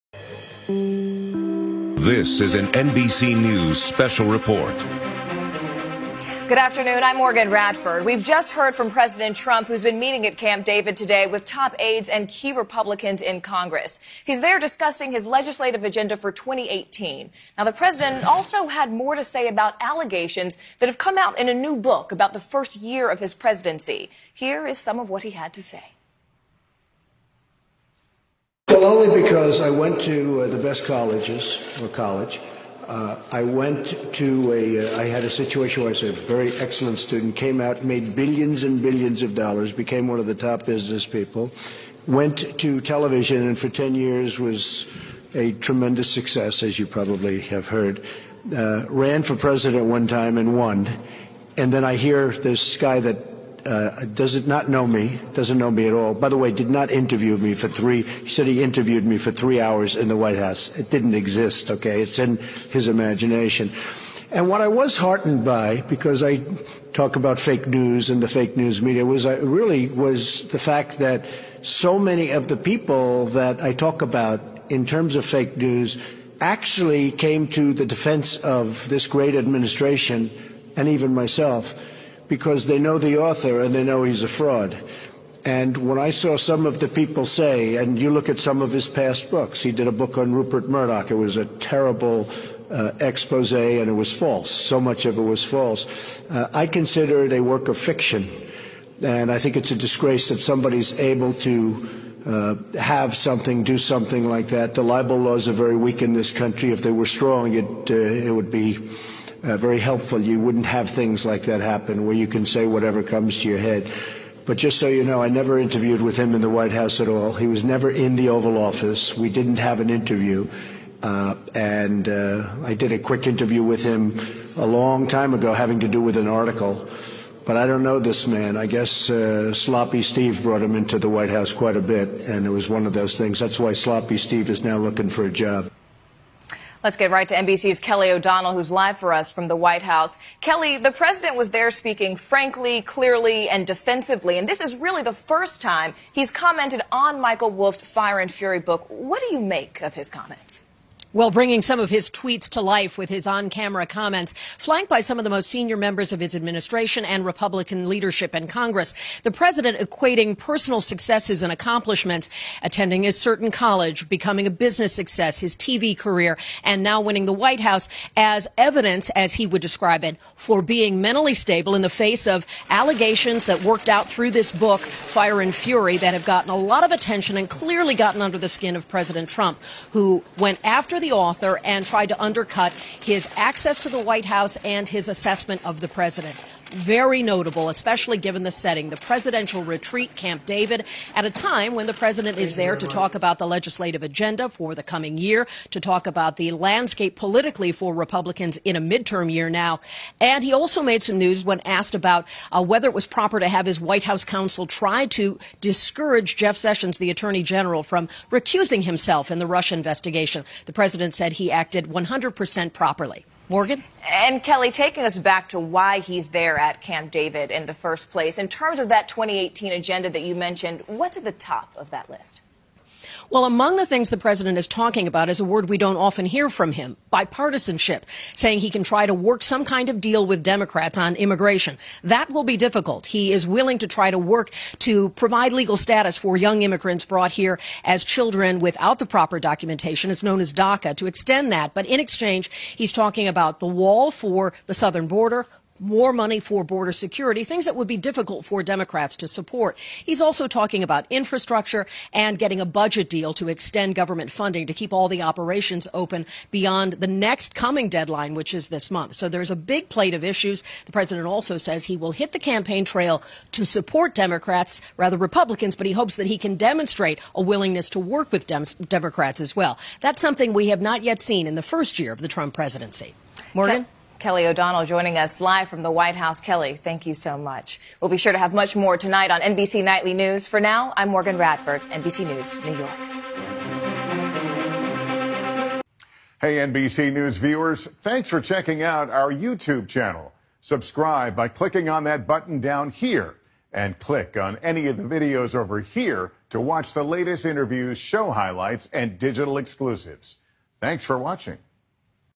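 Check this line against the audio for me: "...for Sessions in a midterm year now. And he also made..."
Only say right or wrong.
wrong.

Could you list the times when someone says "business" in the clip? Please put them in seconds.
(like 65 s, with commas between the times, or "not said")
40 s, 164 s.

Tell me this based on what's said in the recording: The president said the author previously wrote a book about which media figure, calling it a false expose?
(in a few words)
Rupert Murdoch.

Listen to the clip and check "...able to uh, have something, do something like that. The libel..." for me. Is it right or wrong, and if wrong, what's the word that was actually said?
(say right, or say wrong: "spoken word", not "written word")
right.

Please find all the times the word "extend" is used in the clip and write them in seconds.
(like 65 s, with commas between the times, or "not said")
241 s, 253 s.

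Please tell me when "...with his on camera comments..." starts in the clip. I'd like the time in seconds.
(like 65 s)
152 s.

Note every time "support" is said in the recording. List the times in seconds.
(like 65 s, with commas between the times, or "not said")
249 s, 263 s.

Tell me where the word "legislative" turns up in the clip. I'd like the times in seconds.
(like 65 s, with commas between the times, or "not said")
15 s, 193 s.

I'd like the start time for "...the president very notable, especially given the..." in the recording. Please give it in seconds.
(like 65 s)
185 s.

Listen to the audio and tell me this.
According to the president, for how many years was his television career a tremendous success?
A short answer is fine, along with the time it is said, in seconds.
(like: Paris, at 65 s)
10, at 43 s.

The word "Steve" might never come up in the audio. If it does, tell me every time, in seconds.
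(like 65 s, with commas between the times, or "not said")
130 s, 134 s.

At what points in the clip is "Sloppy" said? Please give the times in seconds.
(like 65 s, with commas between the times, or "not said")
129 s, 133 s.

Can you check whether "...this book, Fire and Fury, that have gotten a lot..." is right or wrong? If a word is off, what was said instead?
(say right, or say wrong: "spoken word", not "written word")
right.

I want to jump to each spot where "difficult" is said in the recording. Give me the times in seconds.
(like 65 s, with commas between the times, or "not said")
232 s, 247 s.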